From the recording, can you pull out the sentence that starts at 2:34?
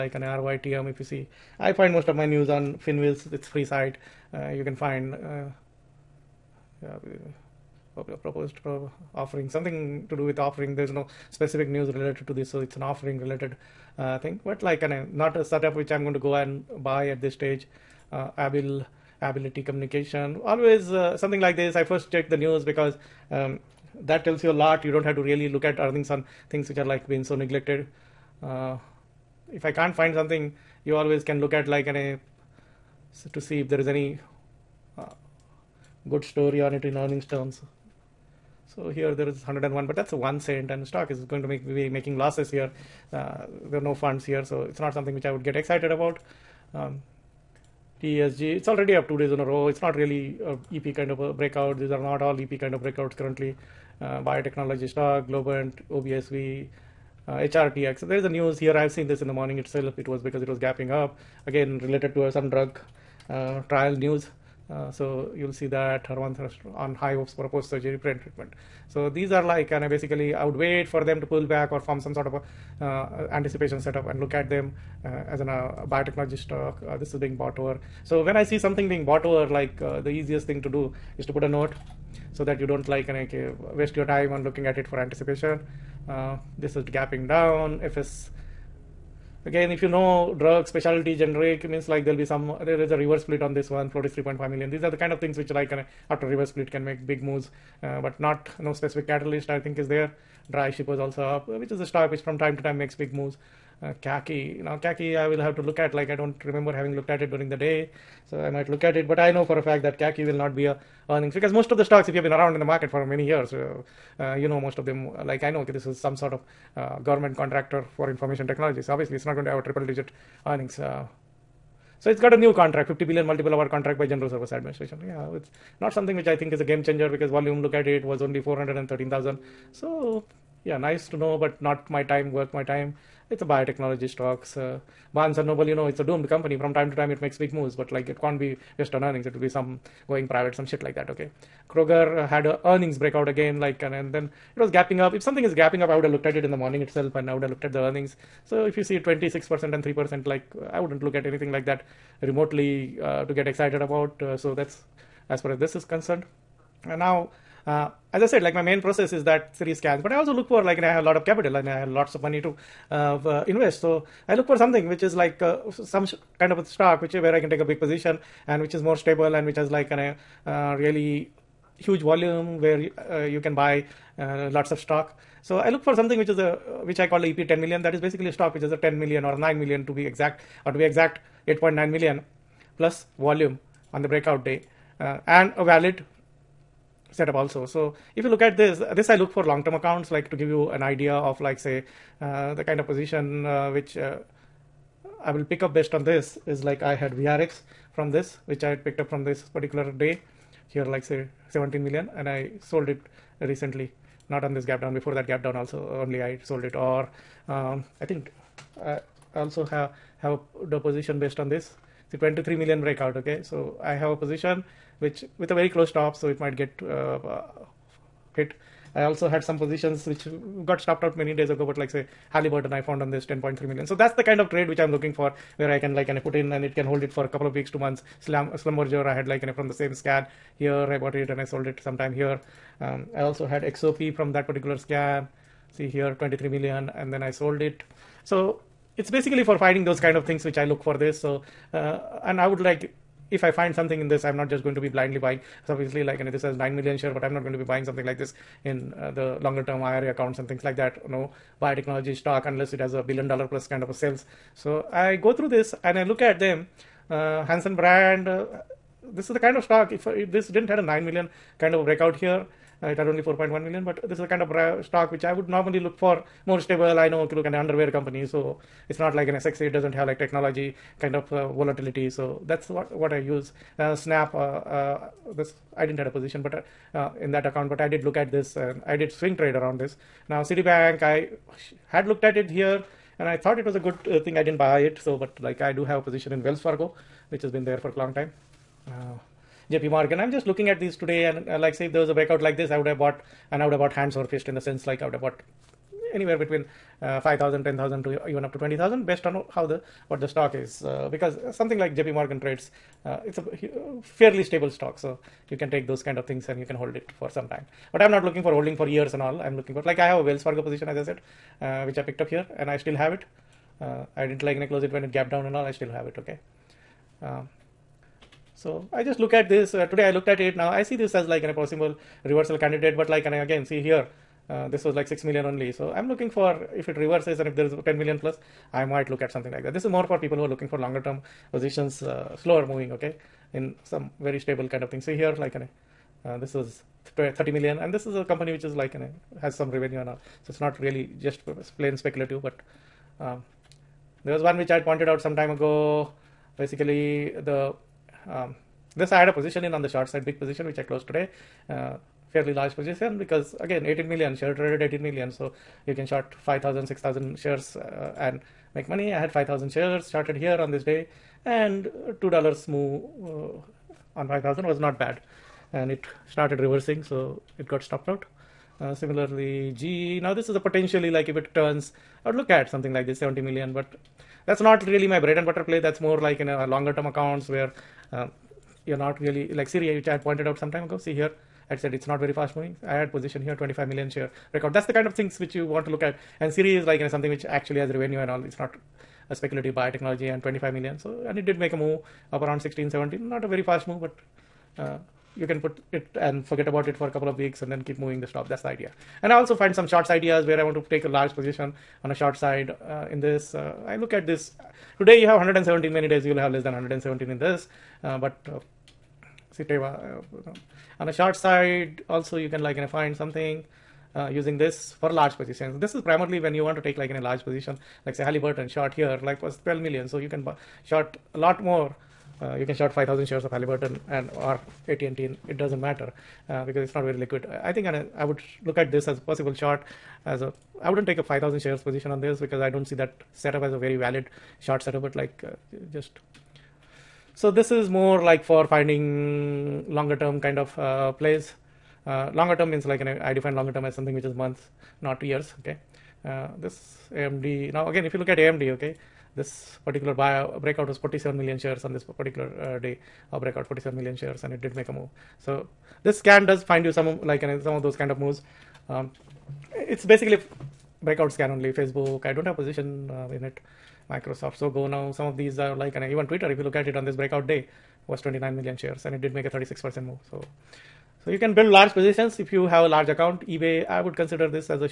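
Uh, so that's as far as this is concerned.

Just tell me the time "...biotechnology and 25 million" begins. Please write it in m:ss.
6:29.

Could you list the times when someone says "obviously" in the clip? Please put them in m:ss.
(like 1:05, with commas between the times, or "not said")
1:58, 4:05.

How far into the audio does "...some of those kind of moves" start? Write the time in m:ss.
7:37.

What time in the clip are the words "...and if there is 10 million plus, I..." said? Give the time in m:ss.
5:27.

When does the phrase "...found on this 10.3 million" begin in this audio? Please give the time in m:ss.
3:42.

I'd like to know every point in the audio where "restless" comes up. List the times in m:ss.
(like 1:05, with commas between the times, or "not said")
not said.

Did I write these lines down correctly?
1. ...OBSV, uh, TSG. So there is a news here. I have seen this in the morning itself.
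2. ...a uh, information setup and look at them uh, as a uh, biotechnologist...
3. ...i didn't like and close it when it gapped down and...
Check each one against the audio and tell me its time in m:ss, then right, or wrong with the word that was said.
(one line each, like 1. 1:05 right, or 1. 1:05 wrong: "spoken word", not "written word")
1. 0:55 wrong: "HRTX", not "TSG"
2. 1:12 wrong: "anticipation", not "information"
3. 5:14 right.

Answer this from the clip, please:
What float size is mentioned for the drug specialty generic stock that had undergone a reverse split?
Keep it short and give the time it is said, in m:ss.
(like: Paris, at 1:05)
3.5 million, at 1:34.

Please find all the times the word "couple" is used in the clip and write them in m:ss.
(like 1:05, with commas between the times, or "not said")
3:47, 6:37.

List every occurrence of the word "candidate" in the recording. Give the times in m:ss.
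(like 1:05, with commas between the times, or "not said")
5:22.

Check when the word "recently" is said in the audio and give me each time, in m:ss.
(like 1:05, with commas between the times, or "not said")
3:23.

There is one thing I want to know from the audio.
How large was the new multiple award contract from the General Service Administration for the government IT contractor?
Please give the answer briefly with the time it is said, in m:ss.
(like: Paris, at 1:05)
50 billion, at 2:02.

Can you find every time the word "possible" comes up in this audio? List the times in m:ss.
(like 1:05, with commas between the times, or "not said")
5:21, 7:09.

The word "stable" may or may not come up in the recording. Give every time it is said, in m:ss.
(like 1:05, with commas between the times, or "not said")
2:48, 4:26, 5:04, 5:34.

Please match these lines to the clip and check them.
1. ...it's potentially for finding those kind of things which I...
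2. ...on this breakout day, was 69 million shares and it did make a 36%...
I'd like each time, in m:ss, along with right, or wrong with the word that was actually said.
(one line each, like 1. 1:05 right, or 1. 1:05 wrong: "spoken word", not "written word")
1. 3:58 wrong: "basically", not "potentially"
2. 7:46 wrong: "29", not "69".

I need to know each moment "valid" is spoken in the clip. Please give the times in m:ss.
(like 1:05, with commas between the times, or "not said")
3:05, 7:13.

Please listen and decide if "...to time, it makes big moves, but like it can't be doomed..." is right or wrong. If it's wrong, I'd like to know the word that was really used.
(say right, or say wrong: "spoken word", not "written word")
wrong: "based", not "doomed".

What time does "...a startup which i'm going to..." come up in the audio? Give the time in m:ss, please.
0:15.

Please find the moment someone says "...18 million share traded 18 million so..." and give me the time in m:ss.
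5:53.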